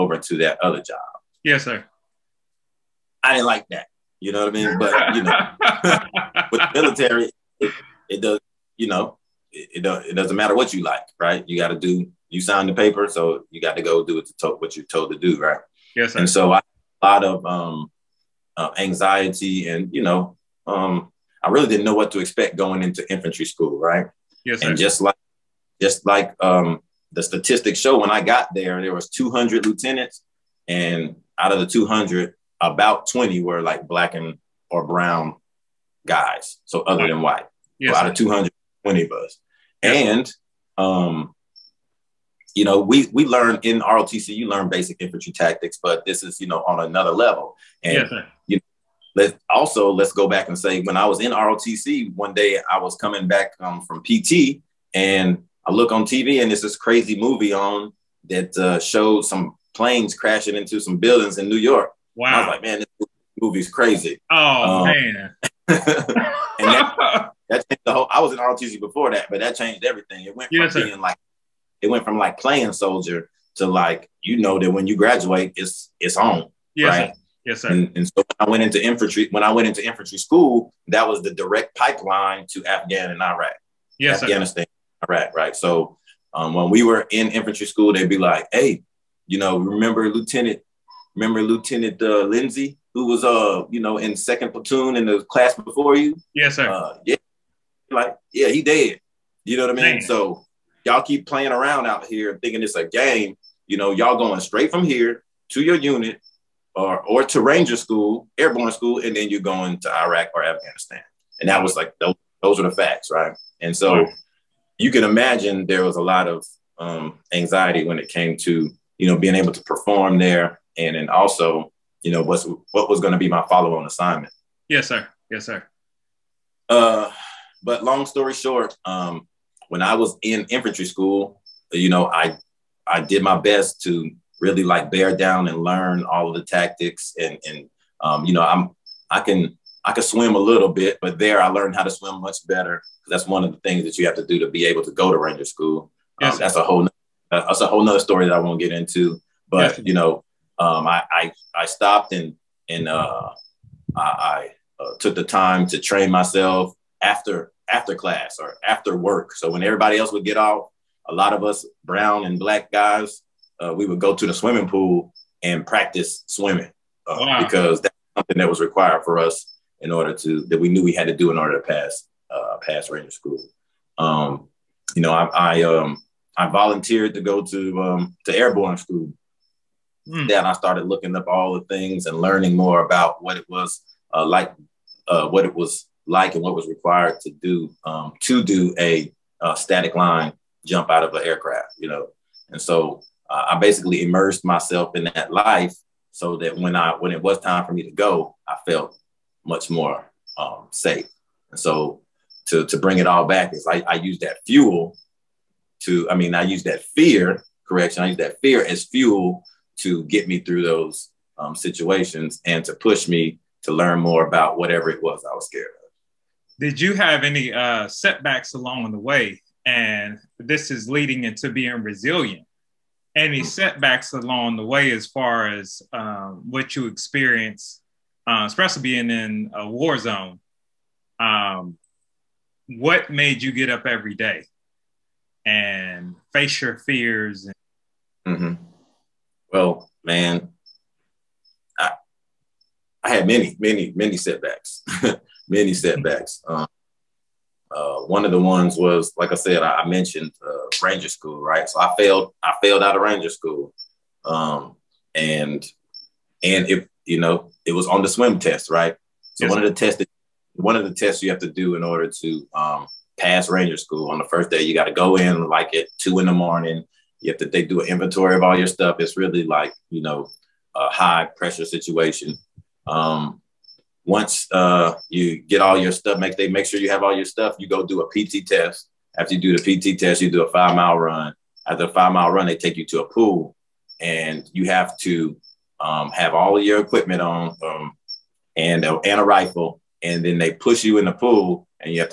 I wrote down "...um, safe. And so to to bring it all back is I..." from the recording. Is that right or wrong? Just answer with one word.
right.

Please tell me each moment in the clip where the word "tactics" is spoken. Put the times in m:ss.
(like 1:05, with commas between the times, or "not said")
0:45, 2:16.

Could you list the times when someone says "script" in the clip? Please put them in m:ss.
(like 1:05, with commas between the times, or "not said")
not said.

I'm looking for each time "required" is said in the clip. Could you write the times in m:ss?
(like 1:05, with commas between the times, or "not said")
2:48, 3:06.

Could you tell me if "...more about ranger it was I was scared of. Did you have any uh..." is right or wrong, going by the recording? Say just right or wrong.
wrong.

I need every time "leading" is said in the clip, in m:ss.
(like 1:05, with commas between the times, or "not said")
3:40.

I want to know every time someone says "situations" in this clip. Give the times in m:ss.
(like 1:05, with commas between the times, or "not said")
3:31, 4:31.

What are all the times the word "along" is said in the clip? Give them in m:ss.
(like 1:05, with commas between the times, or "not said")
3:38, 3:44.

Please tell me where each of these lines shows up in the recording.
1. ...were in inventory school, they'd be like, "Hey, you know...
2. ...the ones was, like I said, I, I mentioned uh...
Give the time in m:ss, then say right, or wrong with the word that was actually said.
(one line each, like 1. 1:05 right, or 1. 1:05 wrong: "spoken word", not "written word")
1. 1:26 wrong: "infantry", not "inventory"
2. 4:08 right.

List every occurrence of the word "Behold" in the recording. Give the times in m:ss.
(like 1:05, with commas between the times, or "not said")
not said.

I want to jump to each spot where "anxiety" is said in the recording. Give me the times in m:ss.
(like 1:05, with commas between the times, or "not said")
0:18, 1:57.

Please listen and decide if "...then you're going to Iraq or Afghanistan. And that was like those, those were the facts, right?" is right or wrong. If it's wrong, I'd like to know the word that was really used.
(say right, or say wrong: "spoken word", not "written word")
right.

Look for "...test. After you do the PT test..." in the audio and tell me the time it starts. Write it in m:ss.
4:38.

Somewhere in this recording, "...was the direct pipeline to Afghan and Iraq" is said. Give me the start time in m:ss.
1:21.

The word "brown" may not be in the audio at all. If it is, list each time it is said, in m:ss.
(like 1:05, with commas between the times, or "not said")
0:34, 2:41.